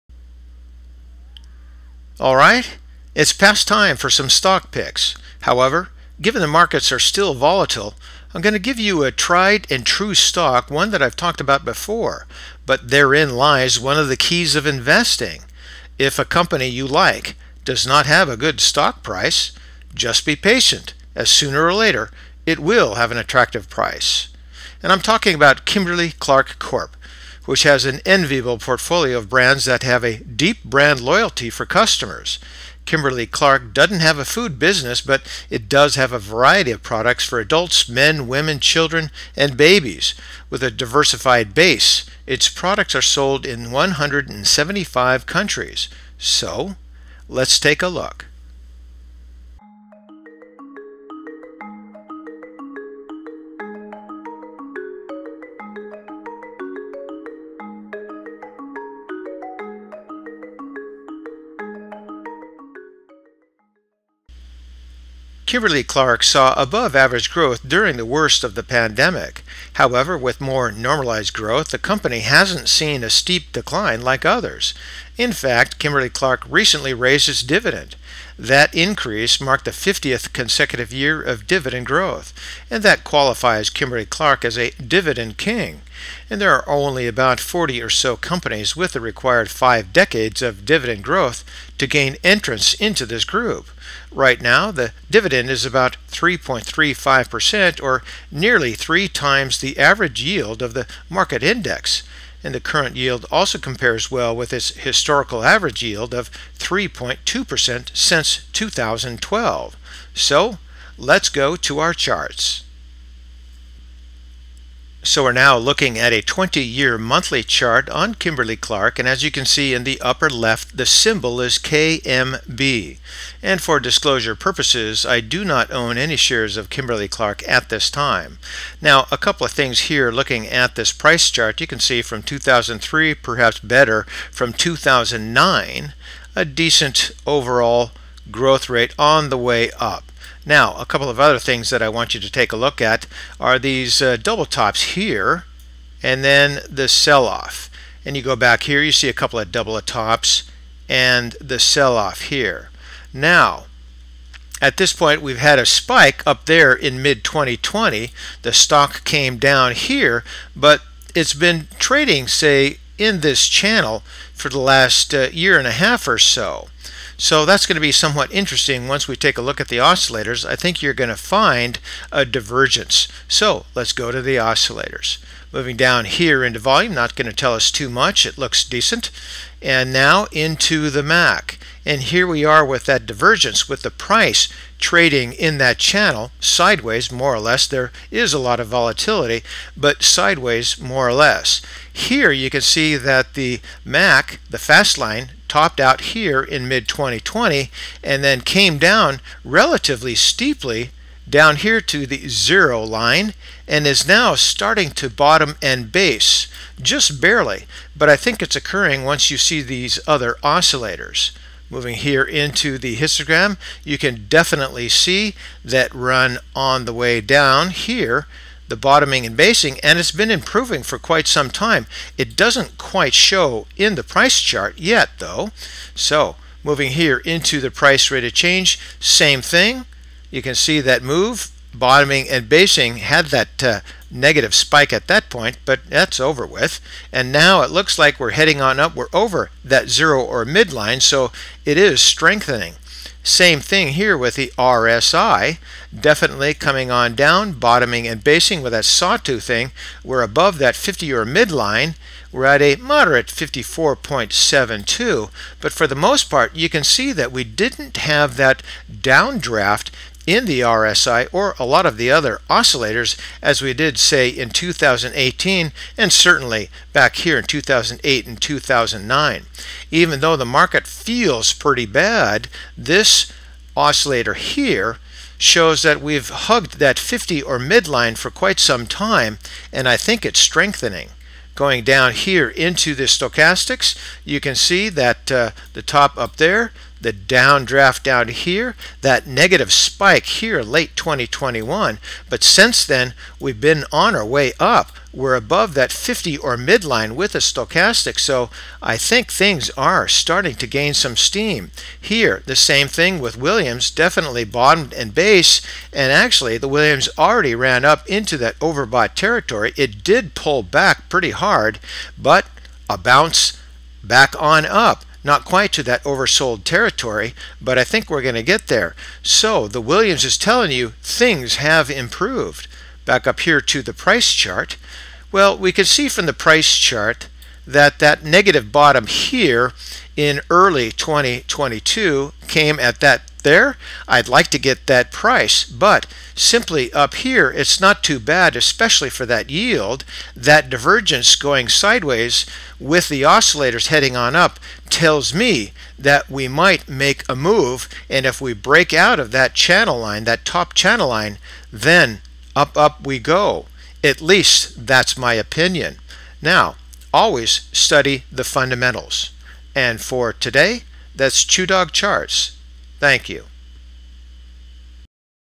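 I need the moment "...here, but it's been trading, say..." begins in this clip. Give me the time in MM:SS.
02:39.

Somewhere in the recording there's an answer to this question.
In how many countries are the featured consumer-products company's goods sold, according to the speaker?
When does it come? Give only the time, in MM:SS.
00:43.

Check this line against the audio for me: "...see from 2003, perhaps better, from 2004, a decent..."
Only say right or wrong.
wrong.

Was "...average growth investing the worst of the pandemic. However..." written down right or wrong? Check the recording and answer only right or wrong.
wrong.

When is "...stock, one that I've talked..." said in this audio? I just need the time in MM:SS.
00:10.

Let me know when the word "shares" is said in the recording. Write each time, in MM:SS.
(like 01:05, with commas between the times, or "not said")
02:06.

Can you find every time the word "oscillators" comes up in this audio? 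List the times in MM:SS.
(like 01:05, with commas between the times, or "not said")
02:49, 02:54, 03:30, 04:22, 04:33, 05:43.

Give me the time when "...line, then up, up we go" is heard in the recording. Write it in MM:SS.
05:51.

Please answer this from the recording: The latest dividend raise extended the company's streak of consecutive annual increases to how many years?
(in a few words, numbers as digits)
50.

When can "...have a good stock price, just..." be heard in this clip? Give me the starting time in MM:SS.
00:18.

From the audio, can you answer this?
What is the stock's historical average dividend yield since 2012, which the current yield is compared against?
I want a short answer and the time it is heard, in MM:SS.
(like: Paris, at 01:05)
3.2%, at 01:46.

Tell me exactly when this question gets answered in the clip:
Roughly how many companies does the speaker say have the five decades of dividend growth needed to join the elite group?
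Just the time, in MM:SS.
01:27.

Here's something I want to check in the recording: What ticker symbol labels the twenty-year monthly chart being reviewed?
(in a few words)
KMB.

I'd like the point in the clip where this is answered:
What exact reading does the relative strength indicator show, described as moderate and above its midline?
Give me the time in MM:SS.
04:13.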